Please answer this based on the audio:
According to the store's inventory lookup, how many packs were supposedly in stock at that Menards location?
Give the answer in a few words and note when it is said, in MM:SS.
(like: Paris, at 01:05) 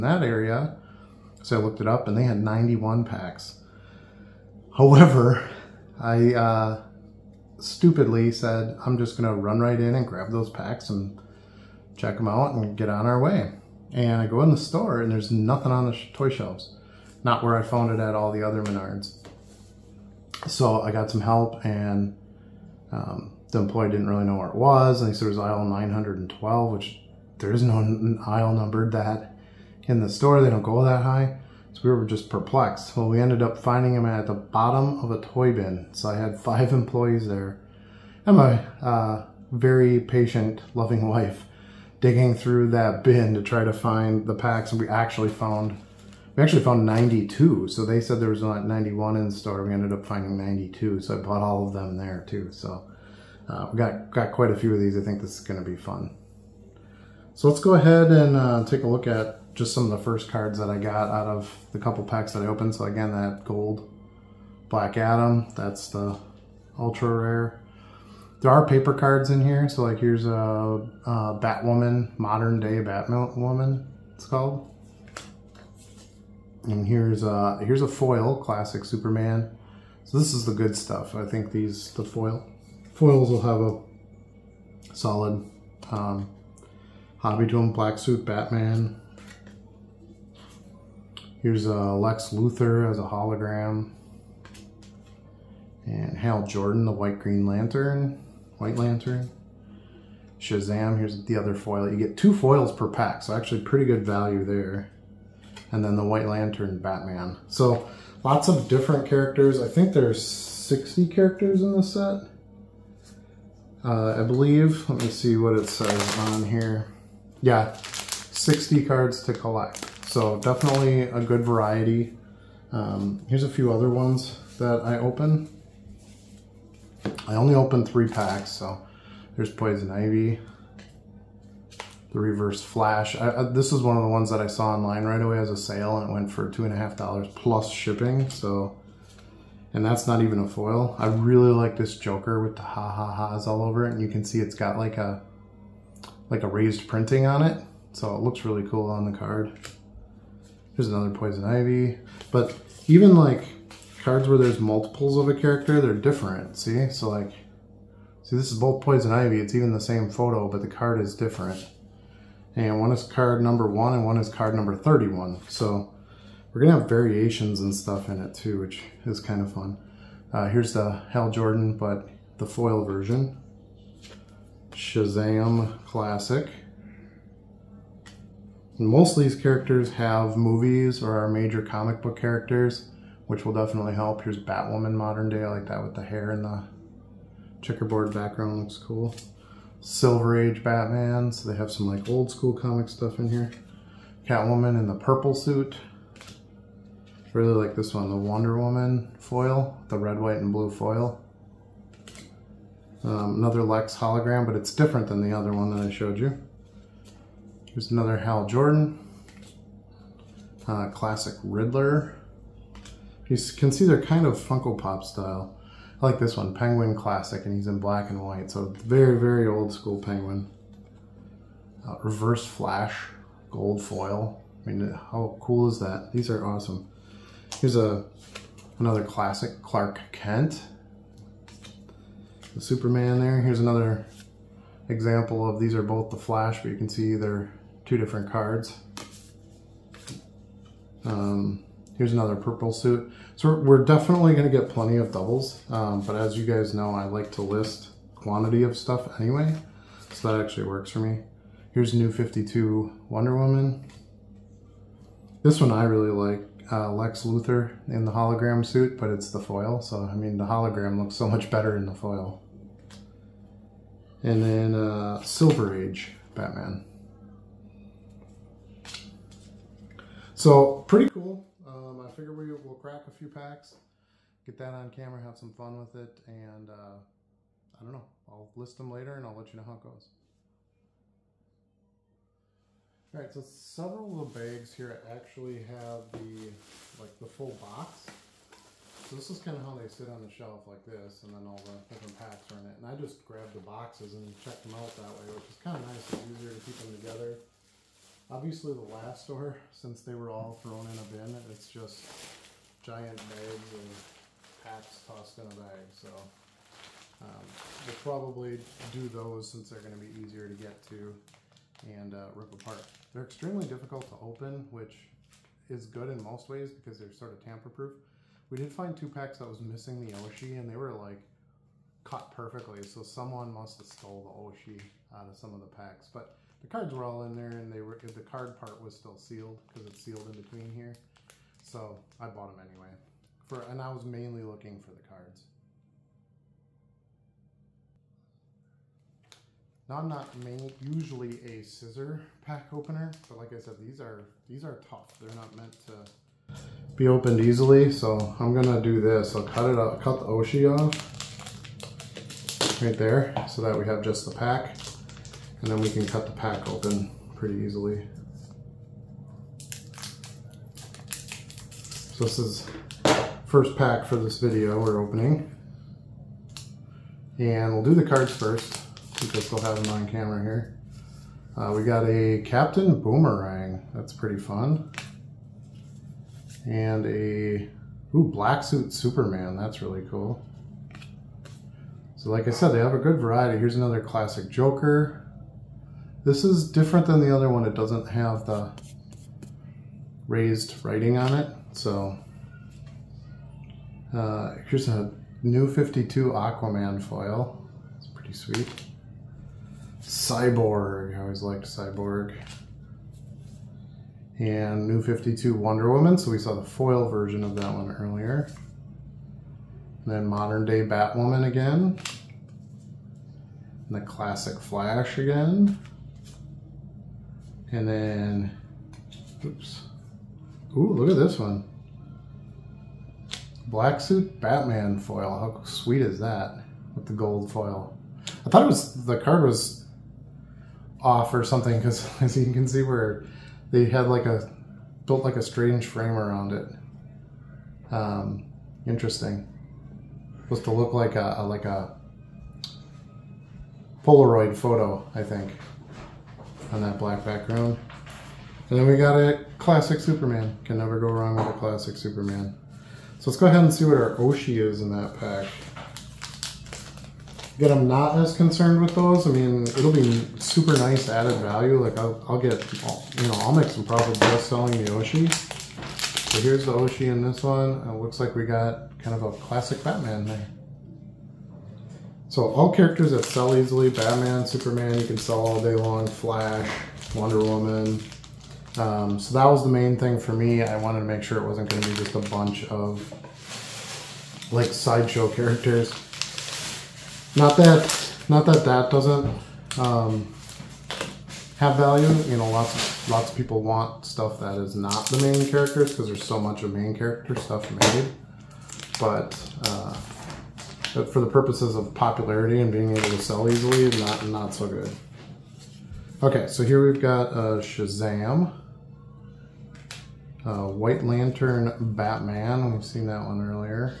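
91, at 00:02.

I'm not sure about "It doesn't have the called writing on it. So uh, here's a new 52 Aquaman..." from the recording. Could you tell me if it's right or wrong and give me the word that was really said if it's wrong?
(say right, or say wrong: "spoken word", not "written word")
wrong: "raised", not "called".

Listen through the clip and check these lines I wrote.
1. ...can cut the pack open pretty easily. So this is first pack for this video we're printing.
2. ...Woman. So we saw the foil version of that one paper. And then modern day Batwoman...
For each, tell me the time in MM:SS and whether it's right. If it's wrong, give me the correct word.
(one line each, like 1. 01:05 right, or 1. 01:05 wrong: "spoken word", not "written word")
1. 05:55 wrong: "opening", not "printing"
2. 06:45 wrong: "earlier", not "paper".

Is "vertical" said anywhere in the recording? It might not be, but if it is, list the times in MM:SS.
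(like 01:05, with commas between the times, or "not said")
not said.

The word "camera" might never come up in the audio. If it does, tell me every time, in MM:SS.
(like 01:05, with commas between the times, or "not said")
04:34, 06:10.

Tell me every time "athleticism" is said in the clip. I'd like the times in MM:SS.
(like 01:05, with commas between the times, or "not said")
not said.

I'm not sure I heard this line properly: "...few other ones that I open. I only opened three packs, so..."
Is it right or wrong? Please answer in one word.
right.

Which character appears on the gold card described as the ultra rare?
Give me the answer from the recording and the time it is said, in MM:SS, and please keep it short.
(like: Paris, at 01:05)
Black Adam, at 01:03.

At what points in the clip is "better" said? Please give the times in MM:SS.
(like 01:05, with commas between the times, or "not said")
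04:21.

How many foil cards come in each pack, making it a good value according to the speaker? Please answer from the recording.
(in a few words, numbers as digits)
2.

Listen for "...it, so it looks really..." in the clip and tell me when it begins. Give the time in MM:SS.
02:27.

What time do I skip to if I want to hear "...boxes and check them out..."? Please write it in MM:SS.
04:53.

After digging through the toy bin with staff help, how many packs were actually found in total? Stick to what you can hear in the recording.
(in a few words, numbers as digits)
92.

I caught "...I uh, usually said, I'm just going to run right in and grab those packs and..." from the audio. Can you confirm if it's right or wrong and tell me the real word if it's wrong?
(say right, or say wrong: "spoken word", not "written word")
wrong: "stupidly", not "usually".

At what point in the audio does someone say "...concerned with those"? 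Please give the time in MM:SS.
07:38.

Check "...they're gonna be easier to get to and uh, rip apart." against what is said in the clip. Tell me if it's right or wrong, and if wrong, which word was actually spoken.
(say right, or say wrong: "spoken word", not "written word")
right.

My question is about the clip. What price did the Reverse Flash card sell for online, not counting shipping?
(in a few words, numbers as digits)
two and a half dollars.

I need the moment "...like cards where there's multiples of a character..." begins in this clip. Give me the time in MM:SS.
02:33.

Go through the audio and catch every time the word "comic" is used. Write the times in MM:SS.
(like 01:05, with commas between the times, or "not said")
03:01, 03:12.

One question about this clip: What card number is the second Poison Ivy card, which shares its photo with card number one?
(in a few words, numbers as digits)
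31.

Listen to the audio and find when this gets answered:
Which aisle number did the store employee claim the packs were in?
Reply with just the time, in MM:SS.
00:25.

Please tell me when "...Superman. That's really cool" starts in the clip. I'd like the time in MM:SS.
06:18.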